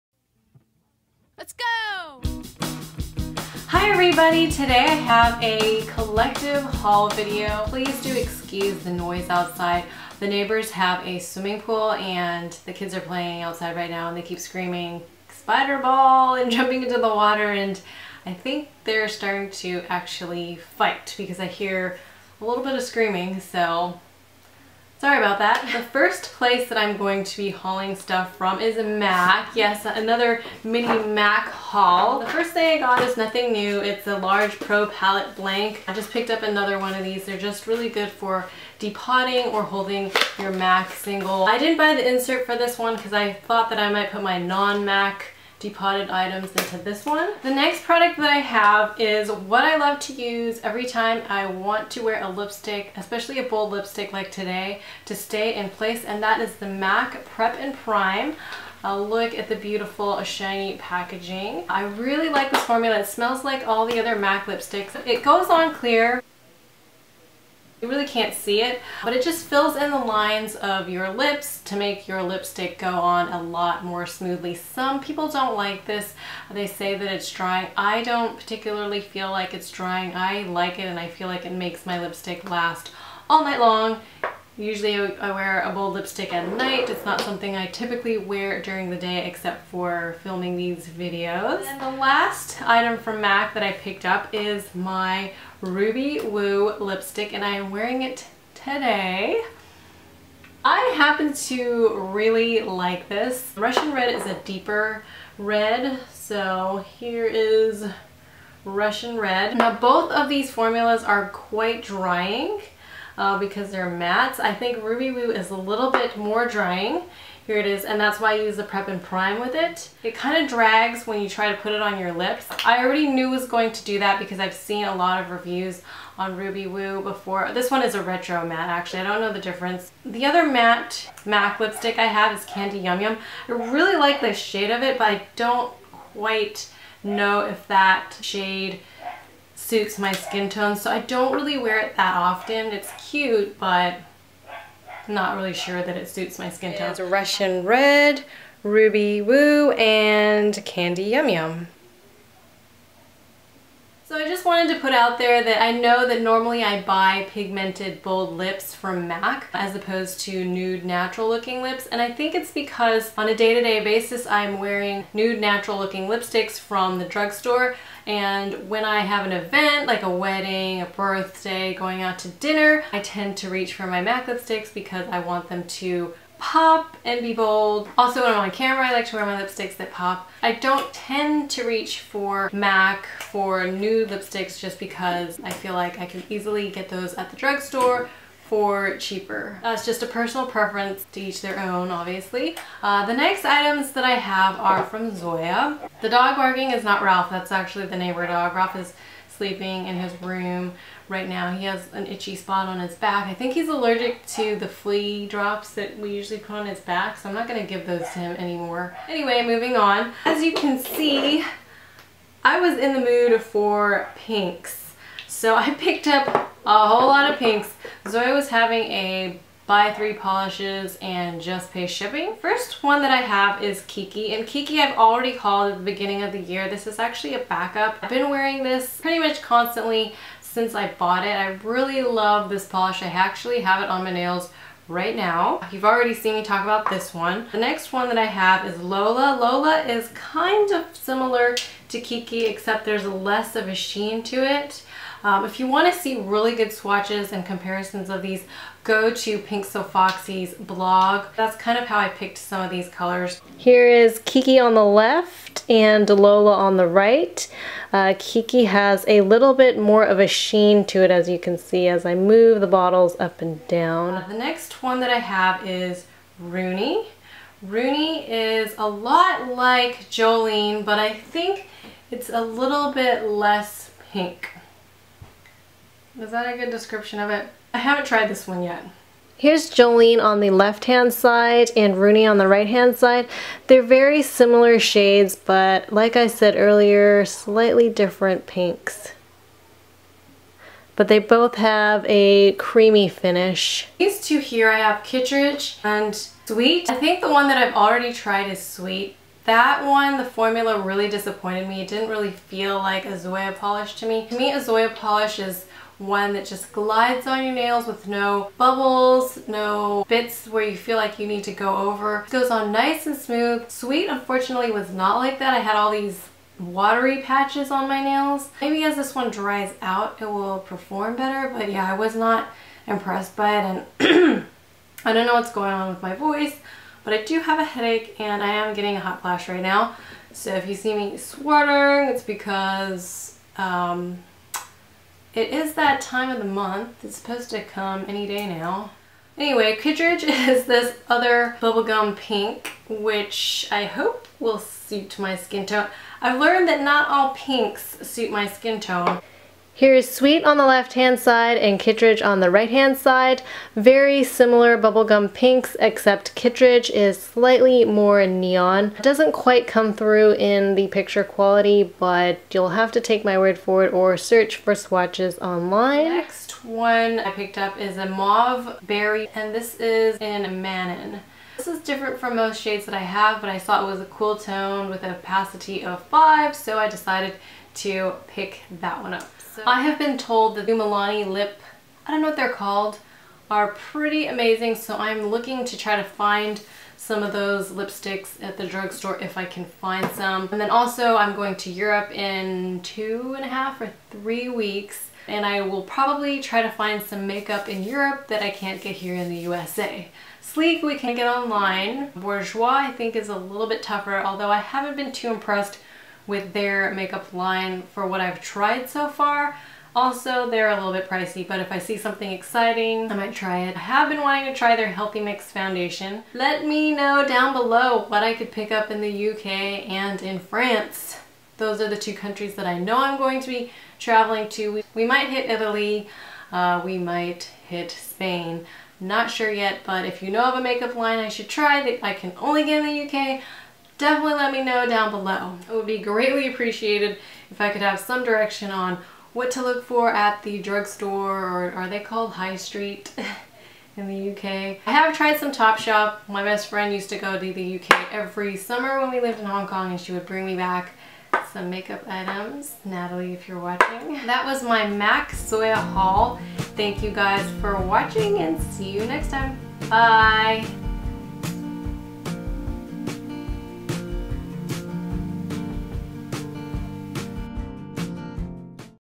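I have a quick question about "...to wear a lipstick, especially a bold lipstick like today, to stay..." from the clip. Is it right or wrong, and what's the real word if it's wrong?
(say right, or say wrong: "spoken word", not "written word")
right.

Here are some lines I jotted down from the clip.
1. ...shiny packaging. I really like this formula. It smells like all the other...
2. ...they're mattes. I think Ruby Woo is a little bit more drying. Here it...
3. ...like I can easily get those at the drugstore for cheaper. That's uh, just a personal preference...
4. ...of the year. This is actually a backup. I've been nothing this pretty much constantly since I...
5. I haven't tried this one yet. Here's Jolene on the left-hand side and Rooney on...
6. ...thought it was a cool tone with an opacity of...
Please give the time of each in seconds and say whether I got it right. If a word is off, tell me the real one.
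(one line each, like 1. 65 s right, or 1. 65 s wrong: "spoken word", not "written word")
1. 60 s right
2. 113 s right
3. 185 s right
4. 226 s wrong: "wearing", not "nothing"
5. 277 s right
6. 373 s right.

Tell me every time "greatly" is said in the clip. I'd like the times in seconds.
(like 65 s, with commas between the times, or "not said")
435 s.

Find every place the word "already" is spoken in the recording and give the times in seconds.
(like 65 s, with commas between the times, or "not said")
122 s, 224 s, 235 s, 297 s.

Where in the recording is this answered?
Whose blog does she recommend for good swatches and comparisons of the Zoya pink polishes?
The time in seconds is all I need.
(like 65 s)
249 s.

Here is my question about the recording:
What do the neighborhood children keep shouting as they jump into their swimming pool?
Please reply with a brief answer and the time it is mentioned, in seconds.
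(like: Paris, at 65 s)
Spider ball, at 15 s.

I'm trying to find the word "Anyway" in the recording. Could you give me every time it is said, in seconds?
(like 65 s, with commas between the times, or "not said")
209 s, 339 s.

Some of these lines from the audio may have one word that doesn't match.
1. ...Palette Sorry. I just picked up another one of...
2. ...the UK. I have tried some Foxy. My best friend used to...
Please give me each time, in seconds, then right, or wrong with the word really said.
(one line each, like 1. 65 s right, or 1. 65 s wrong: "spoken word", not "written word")
1. 34 s wrong: "Blank", not "Sorry"
2. 444 s wrong: "Topshop", not "Foxy".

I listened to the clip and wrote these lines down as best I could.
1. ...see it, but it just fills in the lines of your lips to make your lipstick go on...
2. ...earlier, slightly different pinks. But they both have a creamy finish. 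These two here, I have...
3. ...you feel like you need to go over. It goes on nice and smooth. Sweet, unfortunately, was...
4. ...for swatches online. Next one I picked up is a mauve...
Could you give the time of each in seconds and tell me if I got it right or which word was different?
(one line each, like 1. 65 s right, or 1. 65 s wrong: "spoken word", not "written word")
1. 68 s right
2. 286 s right
3. 310 s right
4. 364 s right.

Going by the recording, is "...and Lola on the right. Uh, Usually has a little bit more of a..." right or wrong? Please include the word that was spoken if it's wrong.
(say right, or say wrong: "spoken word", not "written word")
wrong: "Kiki", not "Usually".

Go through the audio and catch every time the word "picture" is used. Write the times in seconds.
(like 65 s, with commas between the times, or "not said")
360 s.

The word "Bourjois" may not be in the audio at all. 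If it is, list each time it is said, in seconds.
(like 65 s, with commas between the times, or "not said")
402 s.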